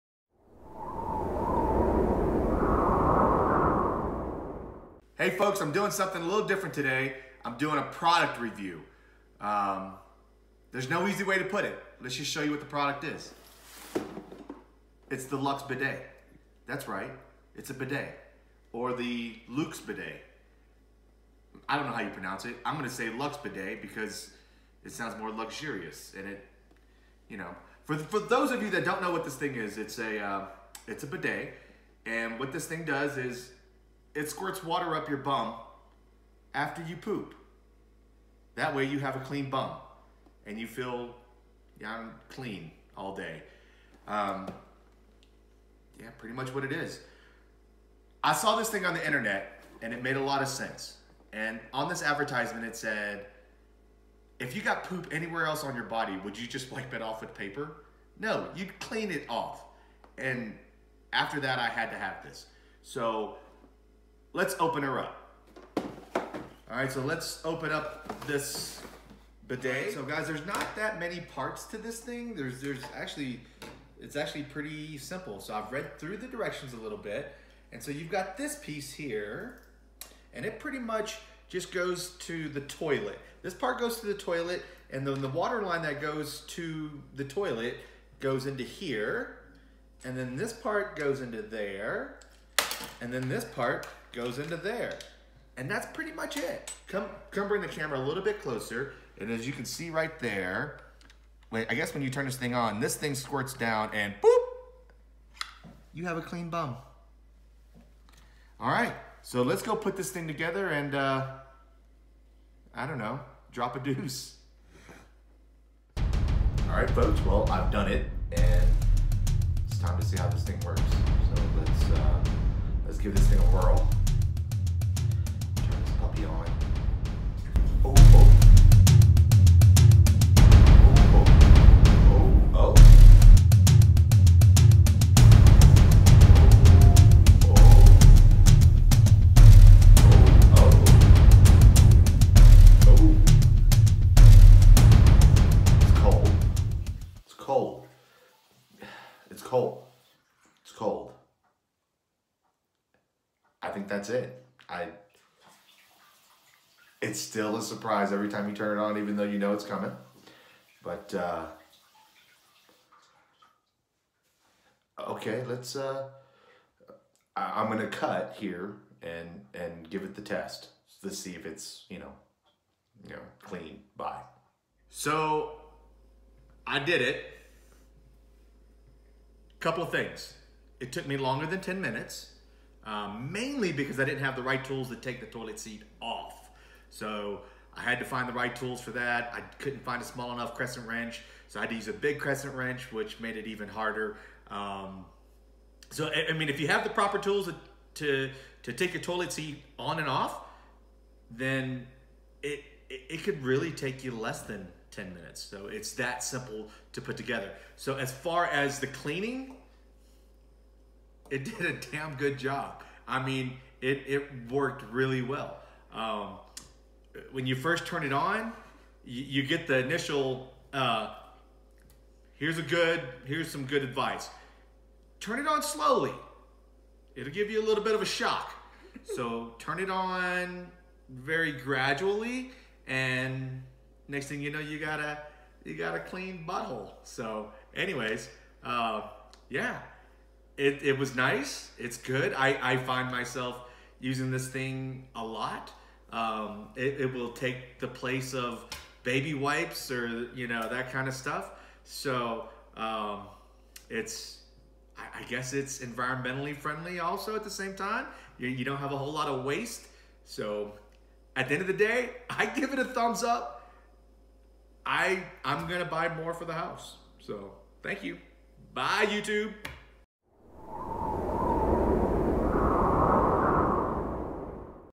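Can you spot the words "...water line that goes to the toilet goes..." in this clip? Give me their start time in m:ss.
1:25.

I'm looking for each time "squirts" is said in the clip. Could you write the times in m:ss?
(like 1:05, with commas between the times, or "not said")
0:34, 1:43.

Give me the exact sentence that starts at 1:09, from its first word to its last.
So guys, there's not that many parts to this thing.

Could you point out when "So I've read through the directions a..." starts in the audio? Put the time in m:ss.
1:15.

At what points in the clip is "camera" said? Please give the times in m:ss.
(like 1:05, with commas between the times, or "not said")
1:37.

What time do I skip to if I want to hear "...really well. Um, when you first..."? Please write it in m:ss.
3:34.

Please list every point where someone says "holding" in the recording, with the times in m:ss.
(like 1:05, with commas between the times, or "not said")
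not said.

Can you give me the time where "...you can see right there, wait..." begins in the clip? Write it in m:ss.
1:39.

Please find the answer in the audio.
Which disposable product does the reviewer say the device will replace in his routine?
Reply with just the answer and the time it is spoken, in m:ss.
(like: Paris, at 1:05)
Baby wipes, at 4:09.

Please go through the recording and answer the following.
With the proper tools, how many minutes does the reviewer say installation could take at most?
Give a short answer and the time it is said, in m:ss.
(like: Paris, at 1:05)
10 minutes, at 3:24.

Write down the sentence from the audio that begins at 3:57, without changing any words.
So, anyways, uh, yeah, it it was nice.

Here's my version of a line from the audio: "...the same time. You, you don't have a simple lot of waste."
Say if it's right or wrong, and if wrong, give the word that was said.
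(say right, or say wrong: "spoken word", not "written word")
wrong: "whole", not "simple".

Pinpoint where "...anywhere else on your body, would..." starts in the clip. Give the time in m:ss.
0:55.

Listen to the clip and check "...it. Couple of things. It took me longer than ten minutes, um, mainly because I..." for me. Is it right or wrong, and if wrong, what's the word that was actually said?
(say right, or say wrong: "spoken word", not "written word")
right.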